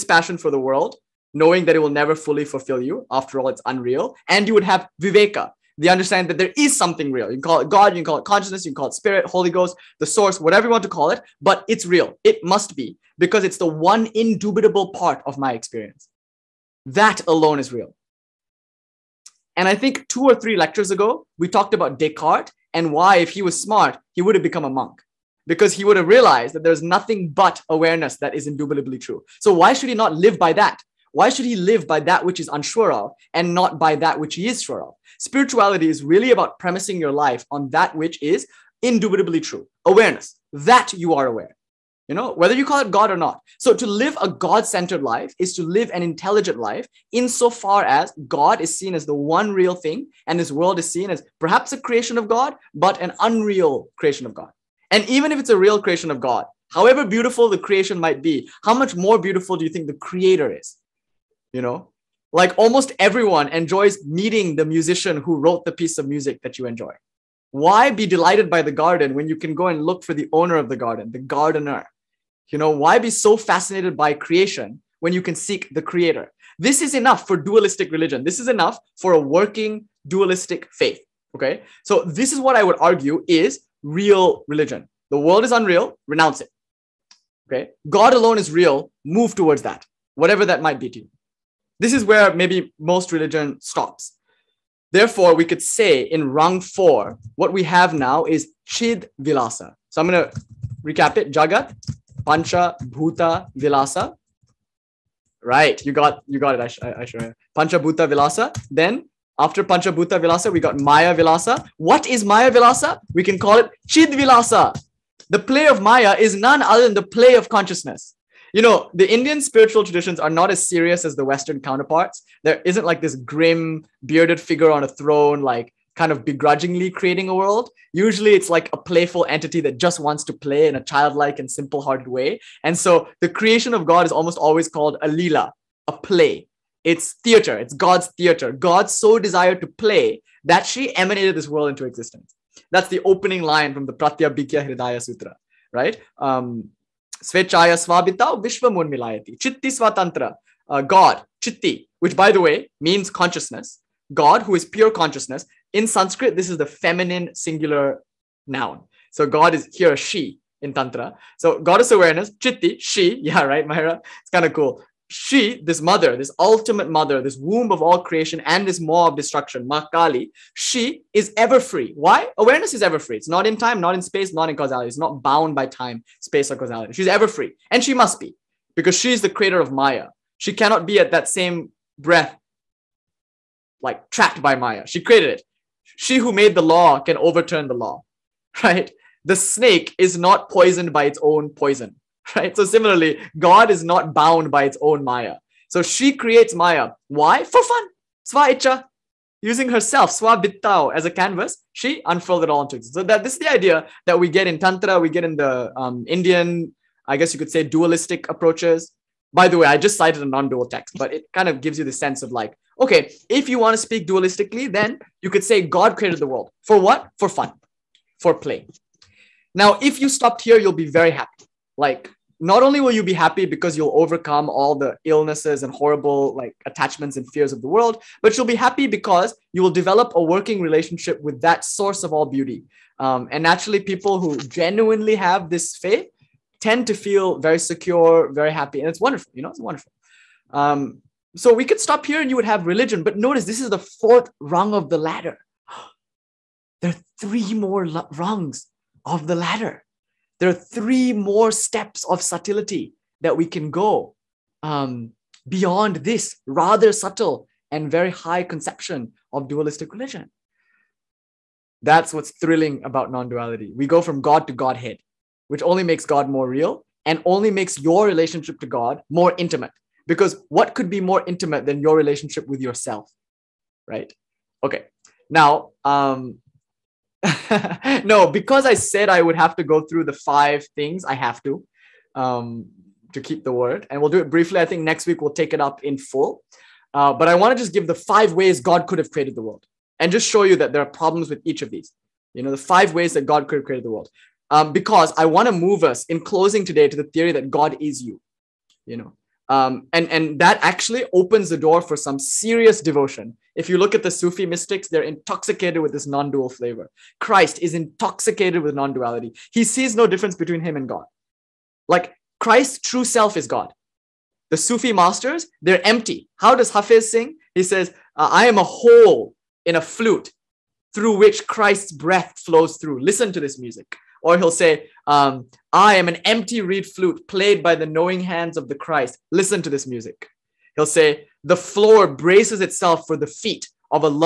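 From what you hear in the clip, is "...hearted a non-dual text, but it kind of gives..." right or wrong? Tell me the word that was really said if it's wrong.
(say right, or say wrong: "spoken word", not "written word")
wrong: "cited", not "hearted".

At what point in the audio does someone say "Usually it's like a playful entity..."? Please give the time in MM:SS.
02:07.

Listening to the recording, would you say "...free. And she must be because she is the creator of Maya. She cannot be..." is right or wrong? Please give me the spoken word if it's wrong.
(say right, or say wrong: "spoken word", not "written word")
right.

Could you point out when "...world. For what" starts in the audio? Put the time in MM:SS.
03:36.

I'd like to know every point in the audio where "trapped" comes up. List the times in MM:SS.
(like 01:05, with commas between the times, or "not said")
03:04.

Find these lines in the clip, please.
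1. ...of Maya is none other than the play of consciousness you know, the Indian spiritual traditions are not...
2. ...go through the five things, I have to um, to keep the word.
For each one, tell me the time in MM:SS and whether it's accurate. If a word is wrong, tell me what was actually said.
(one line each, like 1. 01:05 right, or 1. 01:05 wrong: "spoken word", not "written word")
1. 01:55 right
2. 04:39 right.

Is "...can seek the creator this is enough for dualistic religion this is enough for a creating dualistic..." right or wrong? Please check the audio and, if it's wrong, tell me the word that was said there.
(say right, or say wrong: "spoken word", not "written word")
wrong: "working", not "creating".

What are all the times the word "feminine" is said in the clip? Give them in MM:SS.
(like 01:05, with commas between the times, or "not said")
02:36.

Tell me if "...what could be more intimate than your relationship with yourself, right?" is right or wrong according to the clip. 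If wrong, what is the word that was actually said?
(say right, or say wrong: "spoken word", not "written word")
right.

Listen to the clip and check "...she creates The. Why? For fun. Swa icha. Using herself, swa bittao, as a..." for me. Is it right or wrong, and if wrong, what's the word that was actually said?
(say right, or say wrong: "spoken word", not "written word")
wrong: "Maya", not "The".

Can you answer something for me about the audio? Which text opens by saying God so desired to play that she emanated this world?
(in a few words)
Pratyabhijna Hridaya Sutra.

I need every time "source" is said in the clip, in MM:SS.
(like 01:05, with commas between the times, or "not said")
00:10, 03:51.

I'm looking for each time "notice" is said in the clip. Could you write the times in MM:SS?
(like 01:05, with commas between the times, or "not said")
04:03.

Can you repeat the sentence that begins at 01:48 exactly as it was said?
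Then after Pancha Bhuta Vilasa, we got Maya Vilasa.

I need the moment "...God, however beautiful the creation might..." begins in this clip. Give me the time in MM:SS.
00:56.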